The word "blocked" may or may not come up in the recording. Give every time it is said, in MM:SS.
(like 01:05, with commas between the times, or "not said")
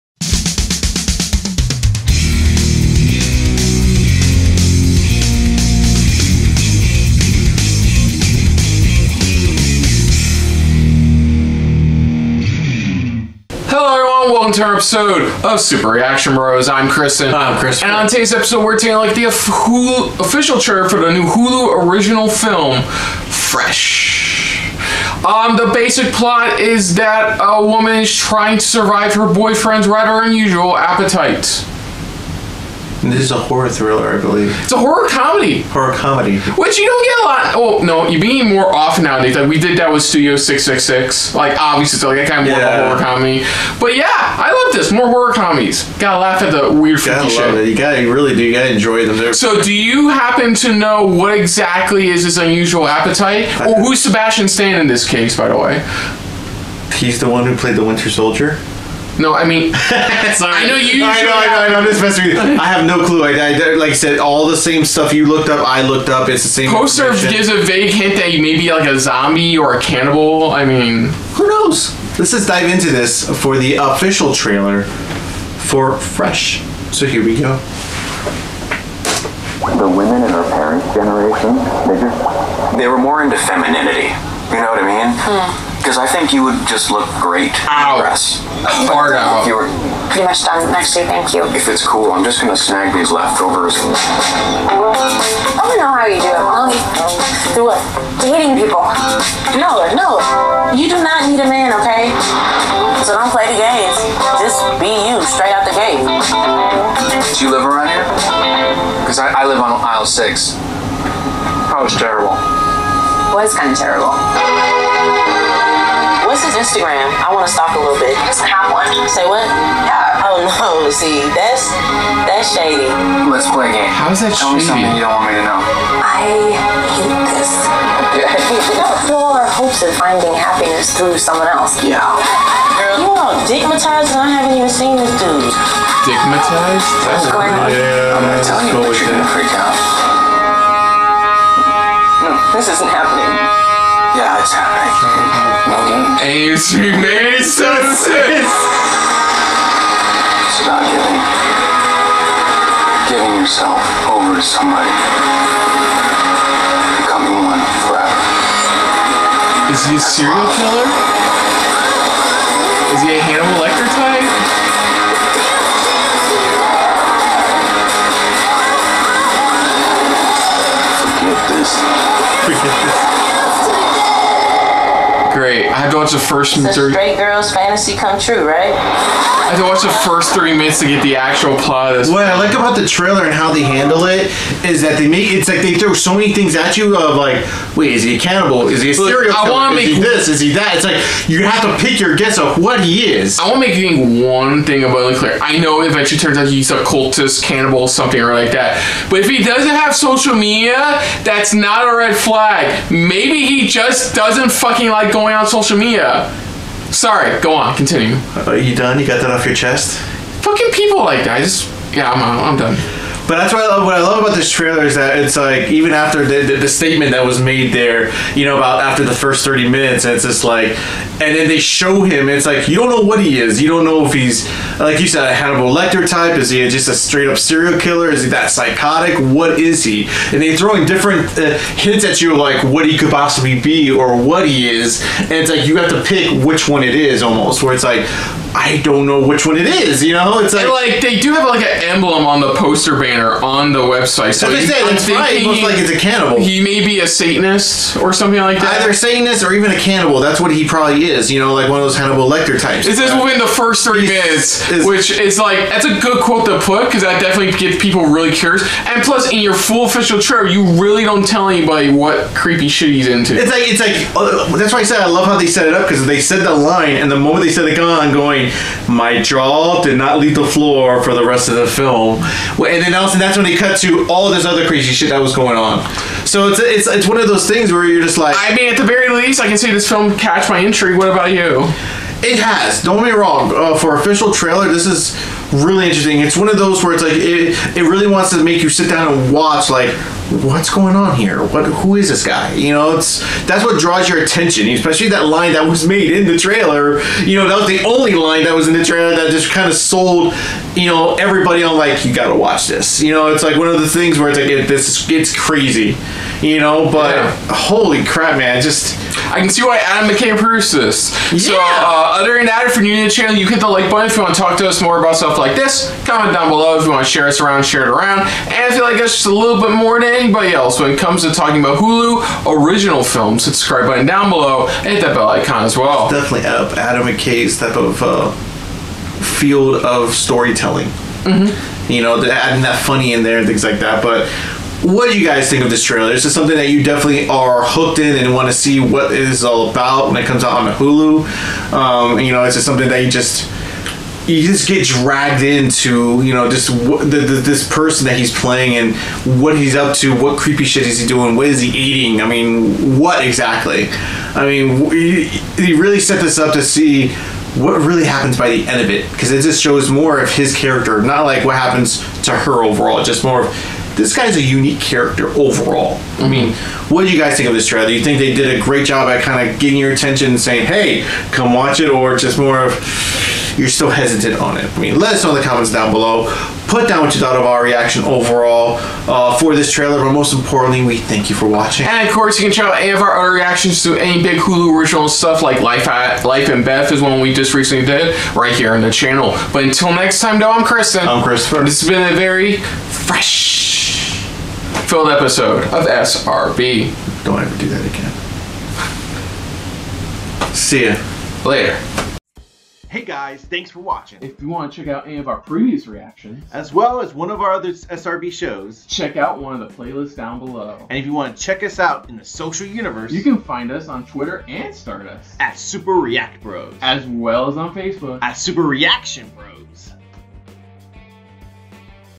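not said.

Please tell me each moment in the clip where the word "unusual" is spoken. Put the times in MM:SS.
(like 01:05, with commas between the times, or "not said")
00:30, 00:52.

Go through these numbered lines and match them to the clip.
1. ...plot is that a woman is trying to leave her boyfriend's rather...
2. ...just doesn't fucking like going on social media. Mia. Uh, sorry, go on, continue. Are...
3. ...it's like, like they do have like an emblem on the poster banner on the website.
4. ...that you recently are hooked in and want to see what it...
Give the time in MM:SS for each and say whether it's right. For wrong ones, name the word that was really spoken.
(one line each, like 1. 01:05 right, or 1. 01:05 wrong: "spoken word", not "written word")
1. 00:26 wrong: "survive", not "leave"
2. 03:23 right
3. 04:00 right
4. 05:36 wrong: "definitely", not "recently".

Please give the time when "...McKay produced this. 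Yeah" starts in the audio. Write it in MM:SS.
05:10.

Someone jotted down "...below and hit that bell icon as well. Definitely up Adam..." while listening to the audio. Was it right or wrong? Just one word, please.
right.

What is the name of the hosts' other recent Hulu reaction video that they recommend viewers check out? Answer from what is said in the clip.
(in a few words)
Life and Beth.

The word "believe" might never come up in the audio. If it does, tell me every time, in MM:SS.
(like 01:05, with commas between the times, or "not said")
00:34.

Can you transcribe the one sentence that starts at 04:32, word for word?
And then also, that's when they cut to all this other crazy shit that was going on.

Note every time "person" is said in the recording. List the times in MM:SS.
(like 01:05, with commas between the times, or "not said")
05:47.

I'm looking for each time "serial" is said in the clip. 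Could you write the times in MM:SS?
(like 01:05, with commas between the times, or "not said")
02:40, 03:08, 03:47.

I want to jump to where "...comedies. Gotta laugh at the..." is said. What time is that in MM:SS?
00:45.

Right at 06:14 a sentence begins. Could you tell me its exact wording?
I mean, let us know in the comments down below.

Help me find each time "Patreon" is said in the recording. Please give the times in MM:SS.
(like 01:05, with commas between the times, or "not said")
not said.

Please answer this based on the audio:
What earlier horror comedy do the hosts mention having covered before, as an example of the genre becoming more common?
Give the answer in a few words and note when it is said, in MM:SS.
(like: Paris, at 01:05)
Studio 666, at 00:40.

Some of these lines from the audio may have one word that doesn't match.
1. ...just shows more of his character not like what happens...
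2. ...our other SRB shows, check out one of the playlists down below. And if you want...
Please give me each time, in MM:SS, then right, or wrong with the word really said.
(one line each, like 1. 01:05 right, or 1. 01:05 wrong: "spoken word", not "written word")
1. 05:59 right
2. 06:47 right.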